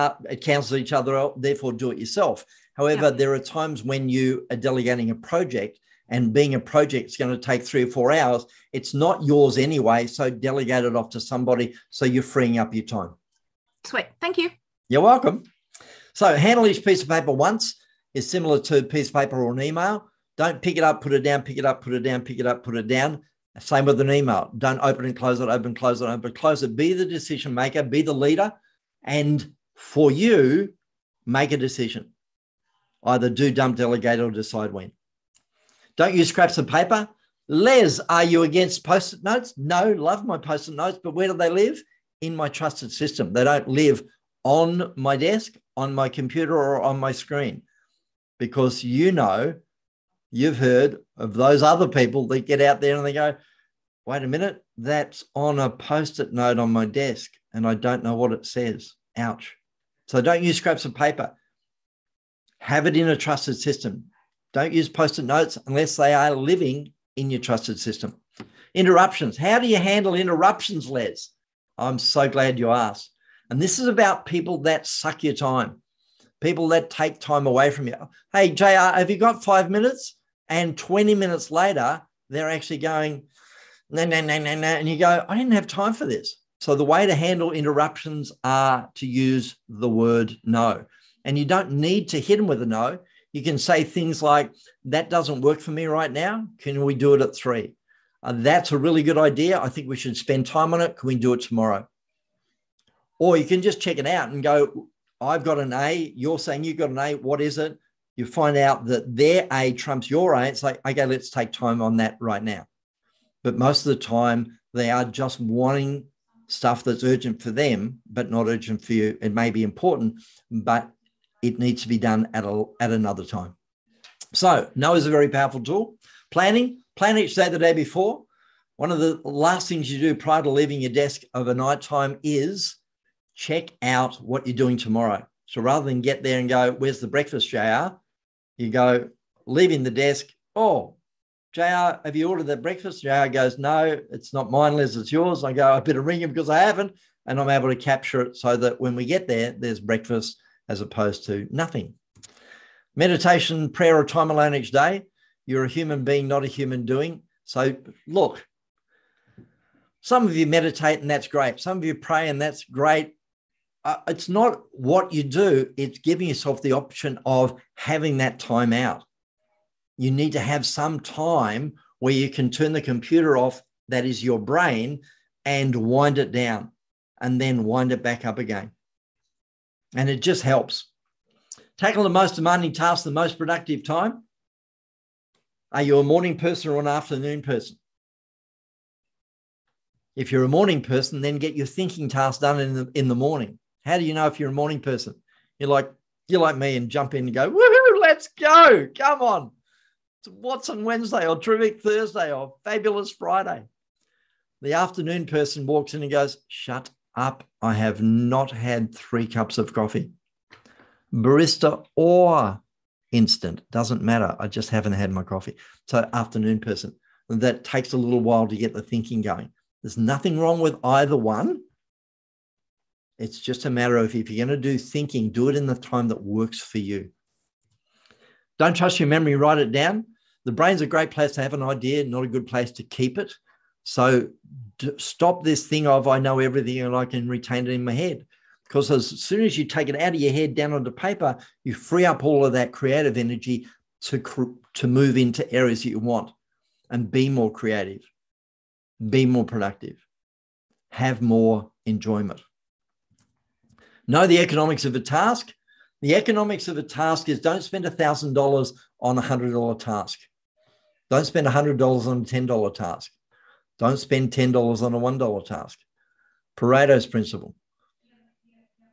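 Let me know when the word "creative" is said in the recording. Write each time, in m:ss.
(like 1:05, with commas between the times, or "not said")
4:02, 4:07.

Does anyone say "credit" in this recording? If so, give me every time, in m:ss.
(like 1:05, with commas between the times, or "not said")
not said.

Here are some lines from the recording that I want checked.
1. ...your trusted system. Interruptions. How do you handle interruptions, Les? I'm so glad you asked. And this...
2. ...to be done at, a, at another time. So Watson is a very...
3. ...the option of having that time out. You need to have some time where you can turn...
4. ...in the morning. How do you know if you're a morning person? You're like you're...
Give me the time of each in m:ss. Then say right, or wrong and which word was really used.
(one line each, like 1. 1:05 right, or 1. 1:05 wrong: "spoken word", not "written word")
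1. 1:07 right
2. 2:01 wrong: "Noah", not "Watson"
3. 2:46 right
4. 3:12 right.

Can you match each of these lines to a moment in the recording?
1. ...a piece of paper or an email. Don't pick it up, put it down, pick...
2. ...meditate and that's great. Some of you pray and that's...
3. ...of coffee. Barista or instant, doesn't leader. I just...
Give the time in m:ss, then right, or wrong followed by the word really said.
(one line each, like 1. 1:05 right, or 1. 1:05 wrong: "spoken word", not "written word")
1. 0:18 right
2. 2:40 right
3. 3:29 wrong: "matter", not "leader".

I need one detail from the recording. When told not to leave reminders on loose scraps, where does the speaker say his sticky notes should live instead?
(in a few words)
In my trusted system.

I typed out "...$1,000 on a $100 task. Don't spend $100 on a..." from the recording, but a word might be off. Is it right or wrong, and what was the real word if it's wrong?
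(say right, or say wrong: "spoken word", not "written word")
right.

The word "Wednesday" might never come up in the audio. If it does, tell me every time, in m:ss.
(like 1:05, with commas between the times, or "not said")
3:20.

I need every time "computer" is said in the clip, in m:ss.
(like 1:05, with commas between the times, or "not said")
0:46, 2:52.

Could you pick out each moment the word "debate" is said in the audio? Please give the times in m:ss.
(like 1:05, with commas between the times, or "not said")
not said.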